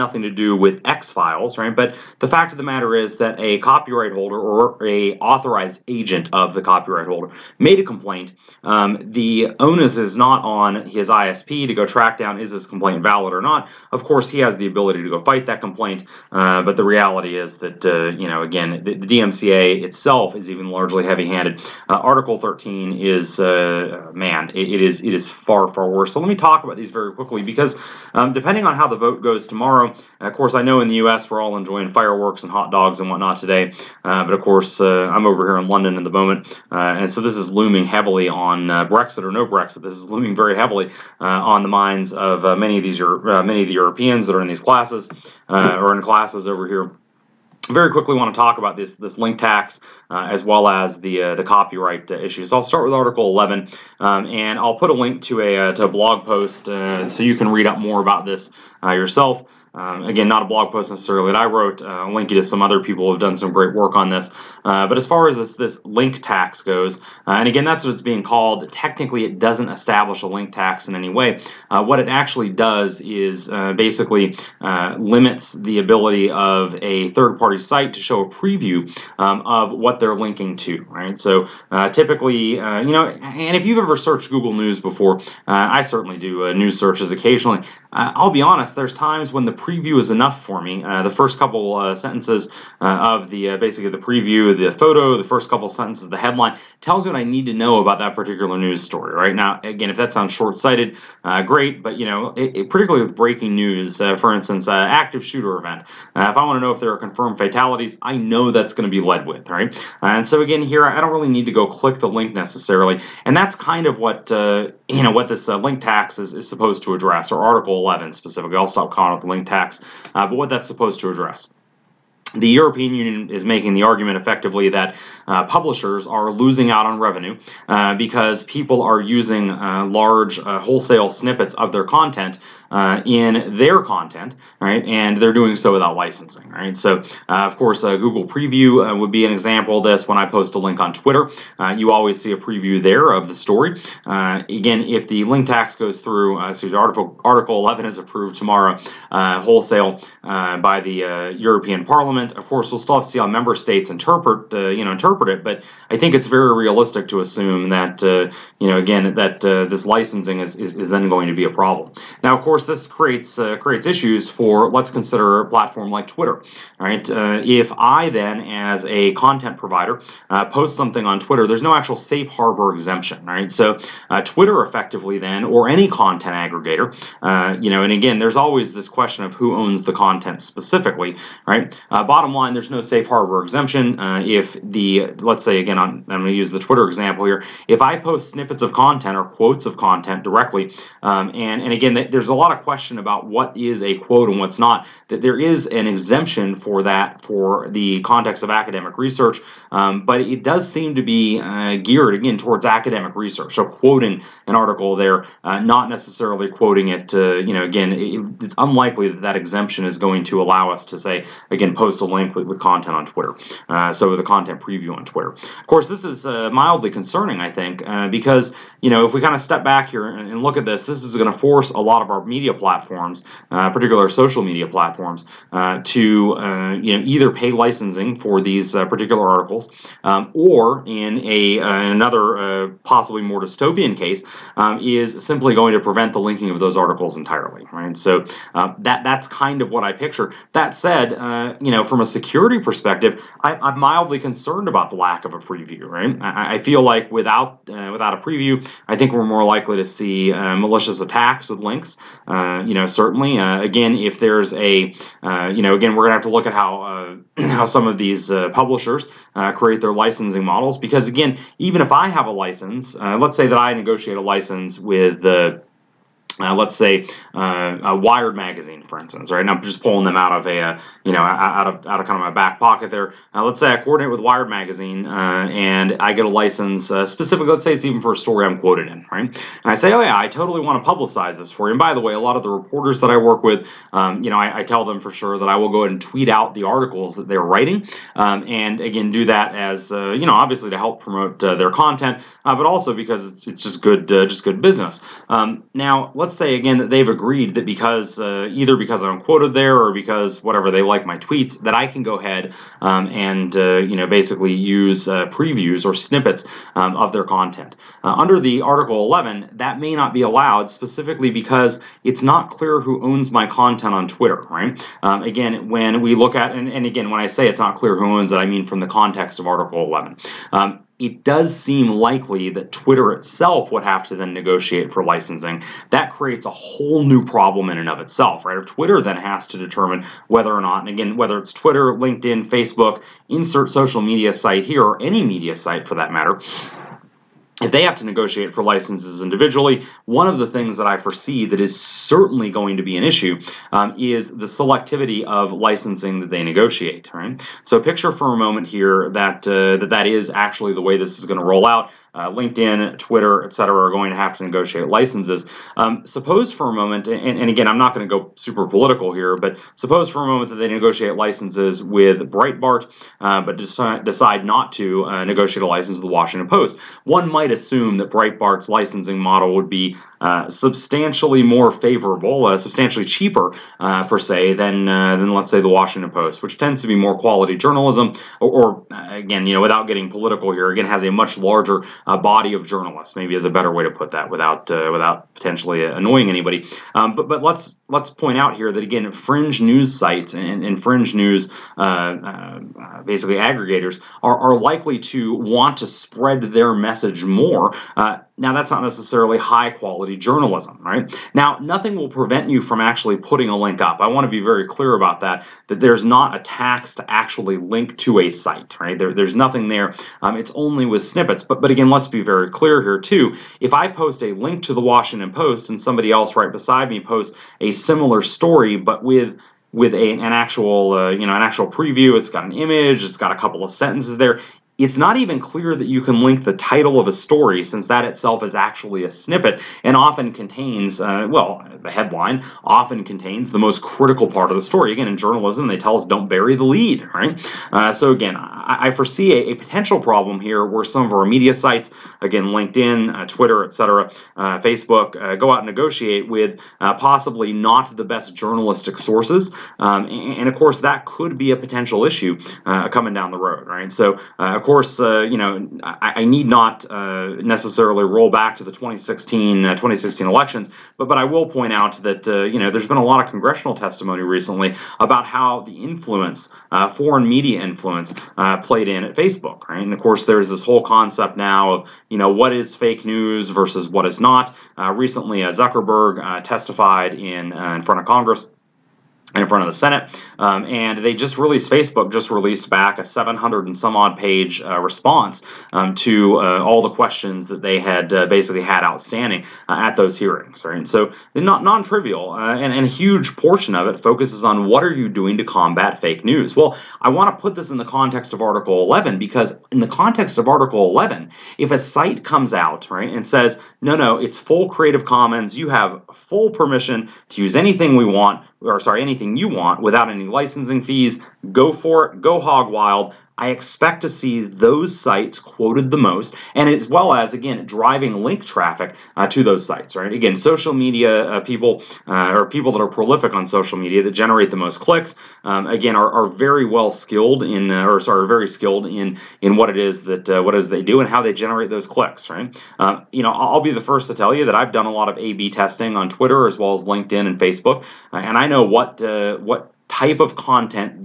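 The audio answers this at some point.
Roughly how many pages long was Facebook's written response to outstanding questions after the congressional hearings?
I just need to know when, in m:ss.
8:03.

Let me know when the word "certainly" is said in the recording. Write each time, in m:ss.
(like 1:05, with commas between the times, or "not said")
1:25, 4:12, 5:41.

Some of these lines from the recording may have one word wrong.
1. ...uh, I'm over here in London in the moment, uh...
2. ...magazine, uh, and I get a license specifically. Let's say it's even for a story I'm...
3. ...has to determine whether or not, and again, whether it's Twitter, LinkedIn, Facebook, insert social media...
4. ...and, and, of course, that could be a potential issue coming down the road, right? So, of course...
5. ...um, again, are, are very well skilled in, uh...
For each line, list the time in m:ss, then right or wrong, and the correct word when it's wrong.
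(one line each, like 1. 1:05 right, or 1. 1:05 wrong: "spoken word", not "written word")
1. 0:34 right
2. 4:34 right
3. 5:29 right
4. 7:30 right
5. 8:45 right.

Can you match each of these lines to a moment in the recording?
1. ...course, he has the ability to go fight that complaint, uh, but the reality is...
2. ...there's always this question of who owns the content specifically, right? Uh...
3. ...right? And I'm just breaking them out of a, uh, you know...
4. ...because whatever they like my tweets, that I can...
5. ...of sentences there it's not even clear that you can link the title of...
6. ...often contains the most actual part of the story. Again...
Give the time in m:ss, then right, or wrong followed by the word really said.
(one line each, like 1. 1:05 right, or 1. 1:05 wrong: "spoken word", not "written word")
1. 0:14 right
2. 2:58 right
3. 4:29 wrong: "pulling", not "breaking"
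4. 4:59 right
5. 7:03 right
6. 7:12 wrong: "critical", not "actual".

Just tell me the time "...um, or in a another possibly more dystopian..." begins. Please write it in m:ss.
3:50.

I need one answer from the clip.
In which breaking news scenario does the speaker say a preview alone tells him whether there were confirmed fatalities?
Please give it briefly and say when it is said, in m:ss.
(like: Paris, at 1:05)
Active shooter event, at 1:44.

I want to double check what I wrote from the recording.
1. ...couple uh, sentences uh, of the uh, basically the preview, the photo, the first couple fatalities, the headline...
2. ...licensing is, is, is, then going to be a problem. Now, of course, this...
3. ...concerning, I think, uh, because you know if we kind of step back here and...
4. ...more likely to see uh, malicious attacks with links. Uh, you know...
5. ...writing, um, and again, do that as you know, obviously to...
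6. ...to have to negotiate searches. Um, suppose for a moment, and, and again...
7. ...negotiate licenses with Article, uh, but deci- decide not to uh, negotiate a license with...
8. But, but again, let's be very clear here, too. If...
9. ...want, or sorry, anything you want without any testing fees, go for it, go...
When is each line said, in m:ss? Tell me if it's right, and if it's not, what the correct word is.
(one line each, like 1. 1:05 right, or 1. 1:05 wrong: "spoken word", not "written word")
1. 1:31 wrong: "sentences", not "fatalities"
2. 2:39 right
3. 3:36 right
4. 4:09 right
5. 4:47 right
6. 5:54 wrong: "licenses", not "searches"
7. 6:00 wrong: "Breitbart", not "Article"
8. 6:51 right
9. 8:28 wrong: "licensing", not "testing".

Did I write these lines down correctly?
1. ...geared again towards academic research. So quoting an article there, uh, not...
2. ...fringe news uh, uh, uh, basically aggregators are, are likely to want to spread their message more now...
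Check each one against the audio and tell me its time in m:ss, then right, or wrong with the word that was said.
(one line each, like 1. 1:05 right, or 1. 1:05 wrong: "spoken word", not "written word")
1. 3:21 right
2. 6:30 right.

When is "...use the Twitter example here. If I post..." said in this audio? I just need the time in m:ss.
3:06.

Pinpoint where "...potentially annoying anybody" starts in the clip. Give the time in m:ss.
6:25.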